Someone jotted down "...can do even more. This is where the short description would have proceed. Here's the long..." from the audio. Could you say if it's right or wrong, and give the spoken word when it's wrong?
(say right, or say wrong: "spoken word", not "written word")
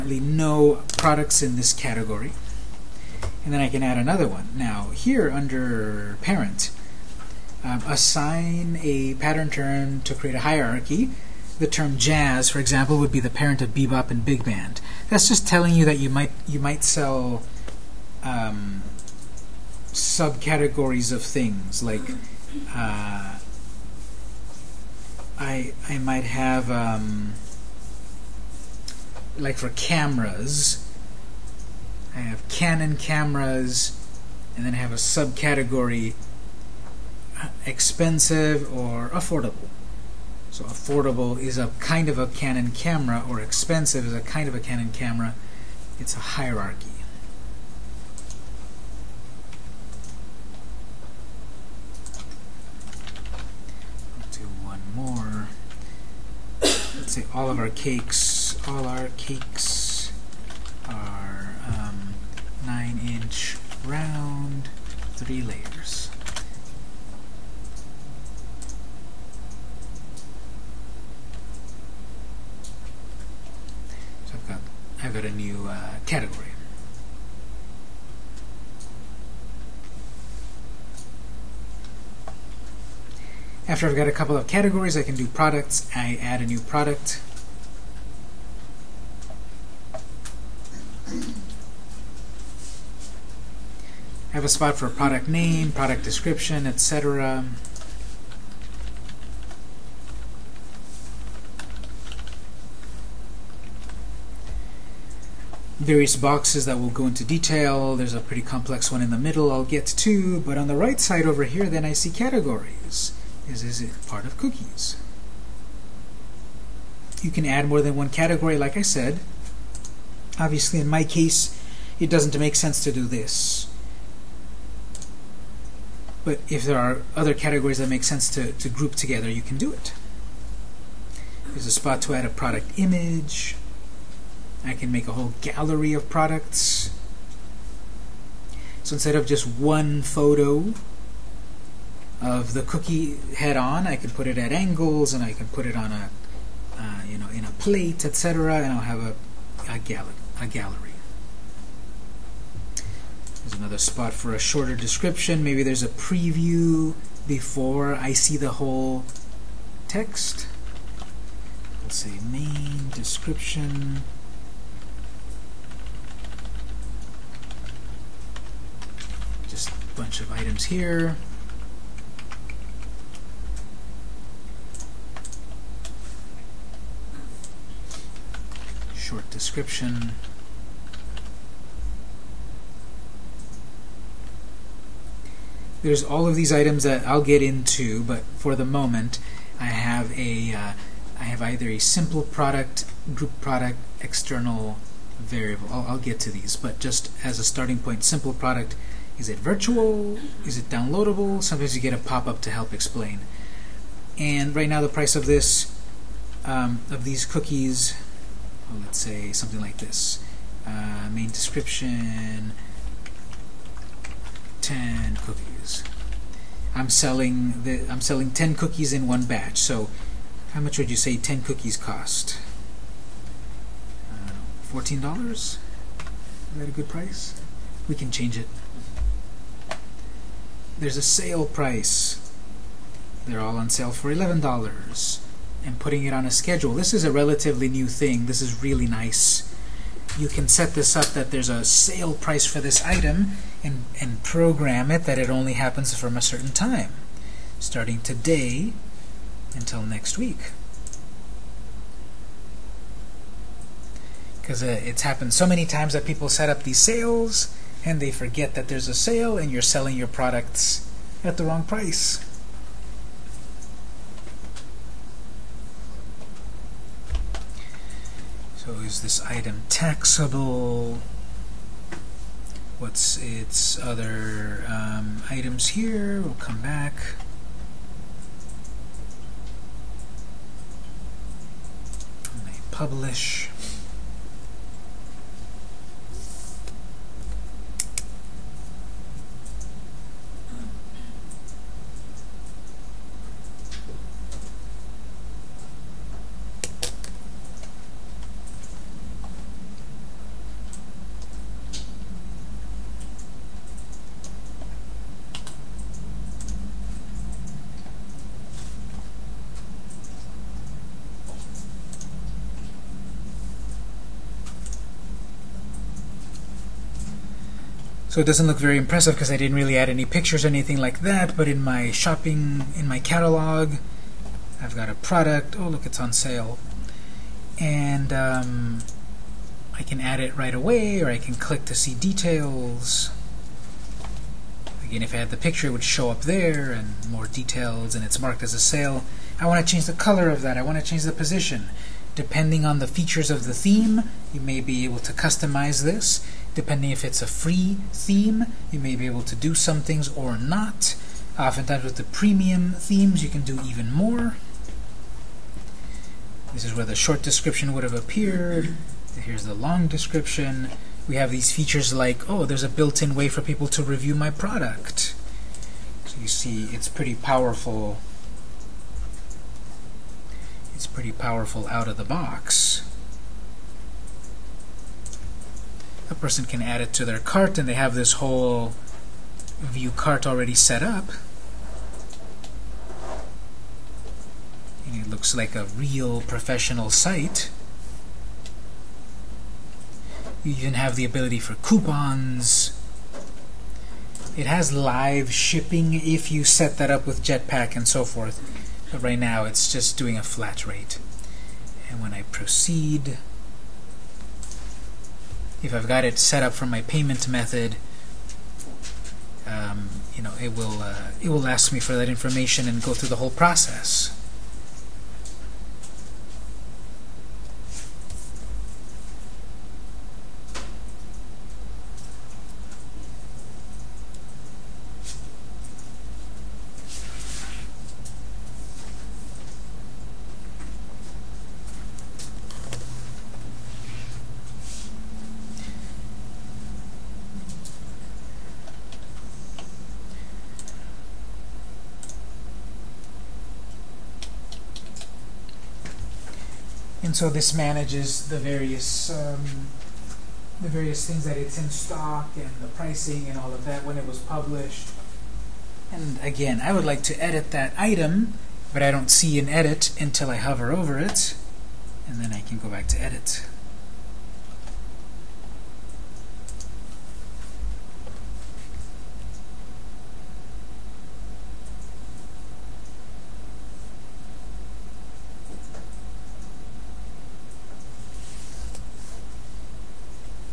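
wrong: "appeared", not "proceed".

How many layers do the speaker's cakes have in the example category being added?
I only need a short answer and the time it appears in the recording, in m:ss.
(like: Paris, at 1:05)
3, at 1:05.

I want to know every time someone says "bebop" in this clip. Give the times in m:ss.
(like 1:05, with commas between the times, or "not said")
0:13.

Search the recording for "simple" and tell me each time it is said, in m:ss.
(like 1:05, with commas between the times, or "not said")
3:11, 3:18.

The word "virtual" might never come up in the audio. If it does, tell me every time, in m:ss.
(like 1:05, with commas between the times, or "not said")
3:19.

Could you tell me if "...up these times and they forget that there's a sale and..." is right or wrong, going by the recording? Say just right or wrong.
wrong.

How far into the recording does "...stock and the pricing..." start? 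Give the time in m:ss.
7:31.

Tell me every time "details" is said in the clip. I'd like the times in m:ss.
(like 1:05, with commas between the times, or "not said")
1:47, 5:31, 5:37.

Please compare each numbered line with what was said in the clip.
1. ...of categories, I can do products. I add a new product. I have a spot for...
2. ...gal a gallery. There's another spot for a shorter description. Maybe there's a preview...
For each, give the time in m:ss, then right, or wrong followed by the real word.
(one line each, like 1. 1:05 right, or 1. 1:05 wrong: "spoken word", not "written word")
1. 1:24 right
2. 2:29 right.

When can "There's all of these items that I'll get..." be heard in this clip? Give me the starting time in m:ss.
3:05.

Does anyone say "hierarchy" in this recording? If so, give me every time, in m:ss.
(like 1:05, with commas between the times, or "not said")
0:10, 0:46.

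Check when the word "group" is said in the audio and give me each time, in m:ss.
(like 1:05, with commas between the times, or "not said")
2:08, 3:13.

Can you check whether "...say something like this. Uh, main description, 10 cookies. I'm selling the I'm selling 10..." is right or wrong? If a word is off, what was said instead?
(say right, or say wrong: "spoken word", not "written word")
right.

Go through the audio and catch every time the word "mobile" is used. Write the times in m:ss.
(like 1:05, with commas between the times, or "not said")
not said.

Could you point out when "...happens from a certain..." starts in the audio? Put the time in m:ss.
4:05.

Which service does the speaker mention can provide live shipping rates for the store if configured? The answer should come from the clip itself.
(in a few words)
Jetpack.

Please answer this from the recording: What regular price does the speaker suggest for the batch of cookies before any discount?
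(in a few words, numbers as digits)
$14.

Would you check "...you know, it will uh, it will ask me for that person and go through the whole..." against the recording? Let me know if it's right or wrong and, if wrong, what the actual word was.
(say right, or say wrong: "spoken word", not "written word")
wrong: "information", not "person".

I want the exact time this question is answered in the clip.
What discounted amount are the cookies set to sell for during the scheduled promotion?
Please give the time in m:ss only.
3:54.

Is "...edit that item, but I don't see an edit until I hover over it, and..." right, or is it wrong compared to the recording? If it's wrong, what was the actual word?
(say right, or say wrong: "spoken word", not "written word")
right.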